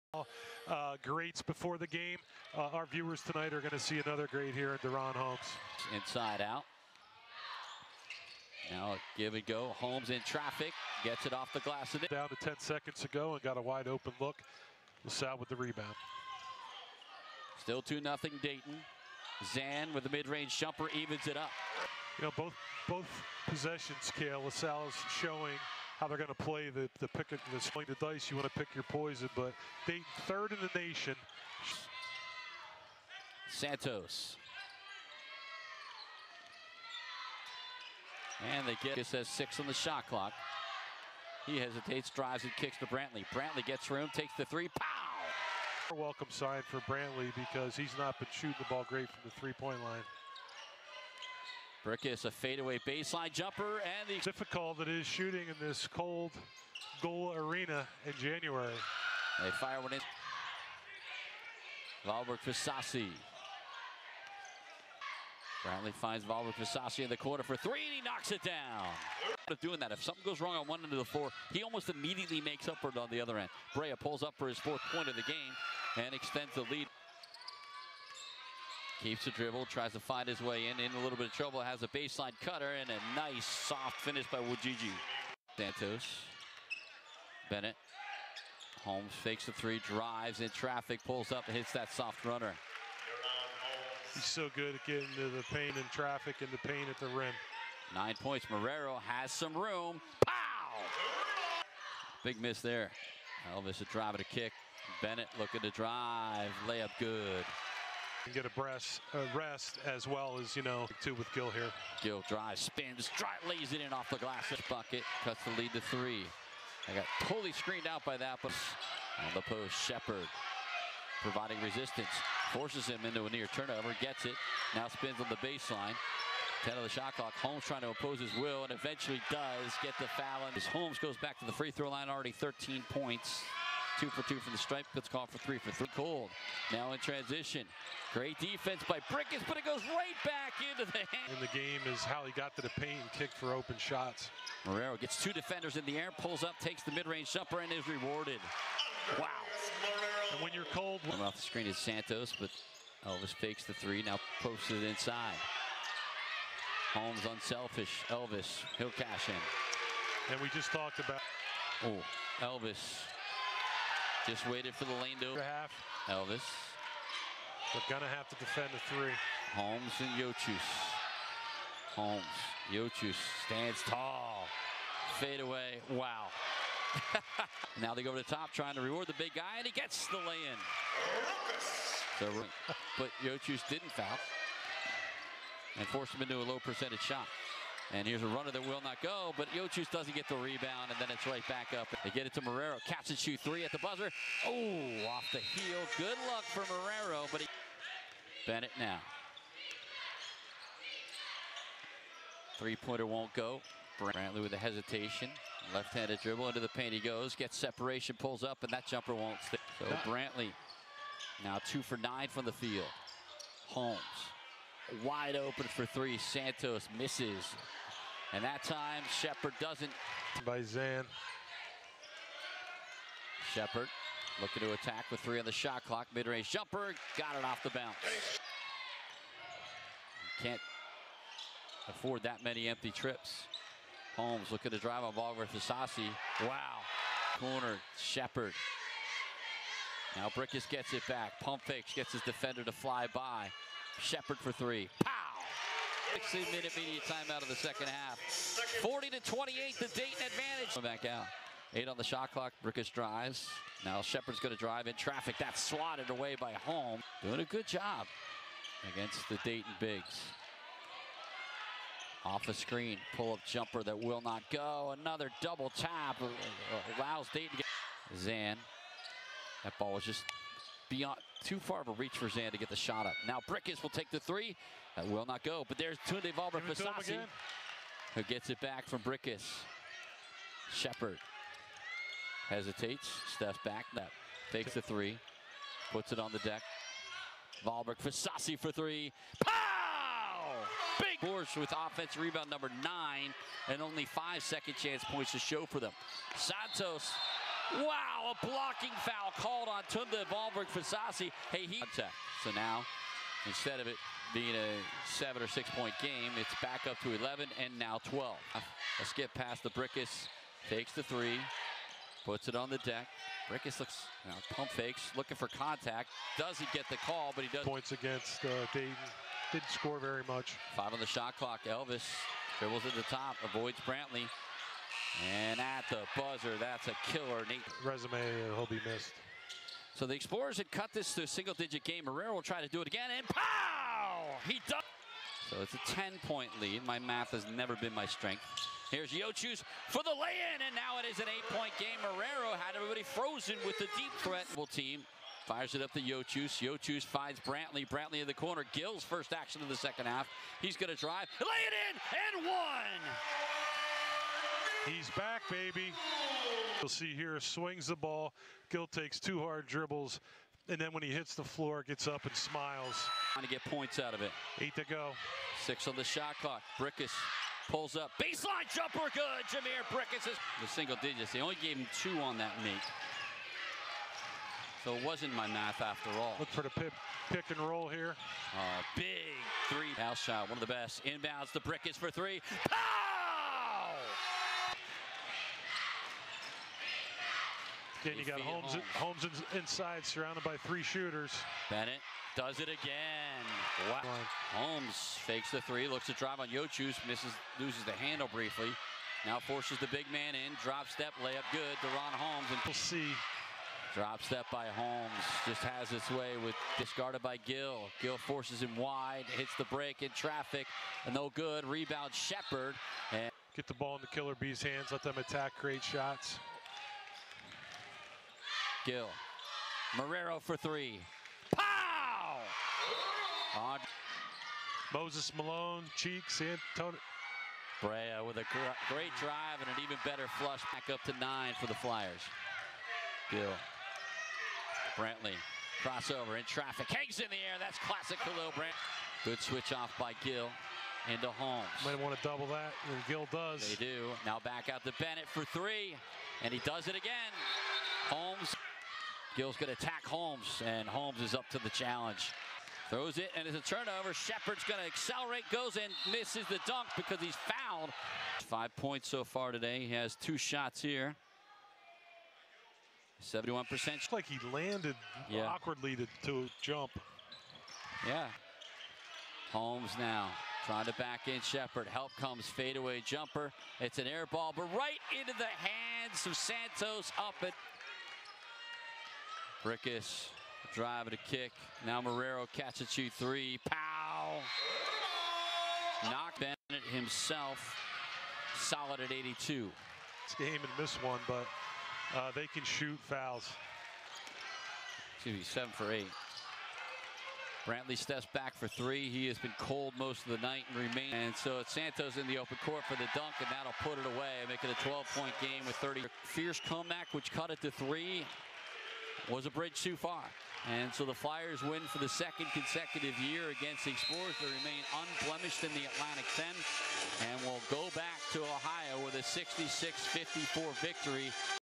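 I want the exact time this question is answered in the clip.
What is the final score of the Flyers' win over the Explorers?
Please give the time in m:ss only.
8:39.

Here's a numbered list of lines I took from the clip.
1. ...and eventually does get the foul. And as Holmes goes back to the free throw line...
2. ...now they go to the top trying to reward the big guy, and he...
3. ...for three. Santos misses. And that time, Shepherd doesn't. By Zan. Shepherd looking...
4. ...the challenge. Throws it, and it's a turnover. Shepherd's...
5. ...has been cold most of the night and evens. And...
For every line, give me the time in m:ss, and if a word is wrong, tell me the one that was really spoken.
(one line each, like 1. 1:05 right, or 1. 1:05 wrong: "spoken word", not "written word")
1. 2:08 right
2. 2:57 right
3. 3:35 right
4. 7:31 right
5. 8:19 wrong: "remains", not "evens".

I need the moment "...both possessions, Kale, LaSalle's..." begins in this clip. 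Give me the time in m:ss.
0:22.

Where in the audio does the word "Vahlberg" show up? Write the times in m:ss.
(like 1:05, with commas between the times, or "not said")
1:02, 1:06, 4:36, 4:47, 5:00.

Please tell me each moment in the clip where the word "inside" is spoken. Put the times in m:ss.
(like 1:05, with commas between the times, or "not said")
0:05, 2:34, 6:29.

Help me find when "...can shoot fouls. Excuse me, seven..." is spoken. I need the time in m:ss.
8:12.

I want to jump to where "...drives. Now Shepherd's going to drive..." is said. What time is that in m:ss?
4:12.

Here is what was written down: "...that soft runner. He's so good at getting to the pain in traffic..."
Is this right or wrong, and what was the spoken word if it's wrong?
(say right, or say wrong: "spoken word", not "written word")
right.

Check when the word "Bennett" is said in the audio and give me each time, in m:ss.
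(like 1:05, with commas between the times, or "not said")
1:27, 1:45, 3:18, 6:31, 7:24, 8:06.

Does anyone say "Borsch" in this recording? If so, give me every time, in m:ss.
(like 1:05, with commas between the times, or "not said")
4:51.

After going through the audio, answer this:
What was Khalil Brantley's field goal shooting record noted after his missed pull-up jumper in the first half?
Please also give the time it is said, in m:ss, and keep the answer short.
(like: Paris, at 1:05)
2 for 9, at 3:31.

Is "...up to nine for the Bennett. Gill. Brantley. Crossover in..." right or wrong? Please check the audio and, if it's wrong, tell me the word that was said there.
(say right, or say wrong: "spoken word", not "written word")
wrong: "Flyers", not "Bennett".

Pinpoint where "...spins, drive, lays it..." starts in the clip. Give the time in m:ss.
1:52.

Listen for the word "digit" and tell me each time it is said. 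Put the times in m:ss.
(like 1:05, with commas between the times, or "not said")
5:31, 6:11.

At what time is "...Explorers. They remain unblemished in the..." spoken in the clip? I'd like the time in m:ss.
8:33.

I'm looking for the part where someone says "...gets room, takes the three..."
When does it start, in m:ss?
0:43.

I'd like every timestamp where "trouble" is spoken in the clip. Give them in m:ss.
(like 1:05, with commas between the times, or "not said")
1:21.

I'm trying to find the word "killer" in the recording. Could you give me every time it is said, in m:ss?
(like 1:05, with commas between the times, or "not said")
5:27, 6:54.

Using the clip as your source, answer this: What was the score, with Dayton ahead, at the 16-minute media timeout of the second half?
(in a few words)
40 to 28.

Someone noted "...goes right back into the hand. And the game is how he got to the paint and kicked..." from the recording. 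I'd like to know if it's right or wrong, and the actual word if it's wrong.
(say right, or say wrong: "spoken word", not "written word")
right.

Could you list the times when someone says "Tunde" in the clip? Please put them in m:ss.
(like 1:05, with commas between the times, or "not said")
4:36, 4:59.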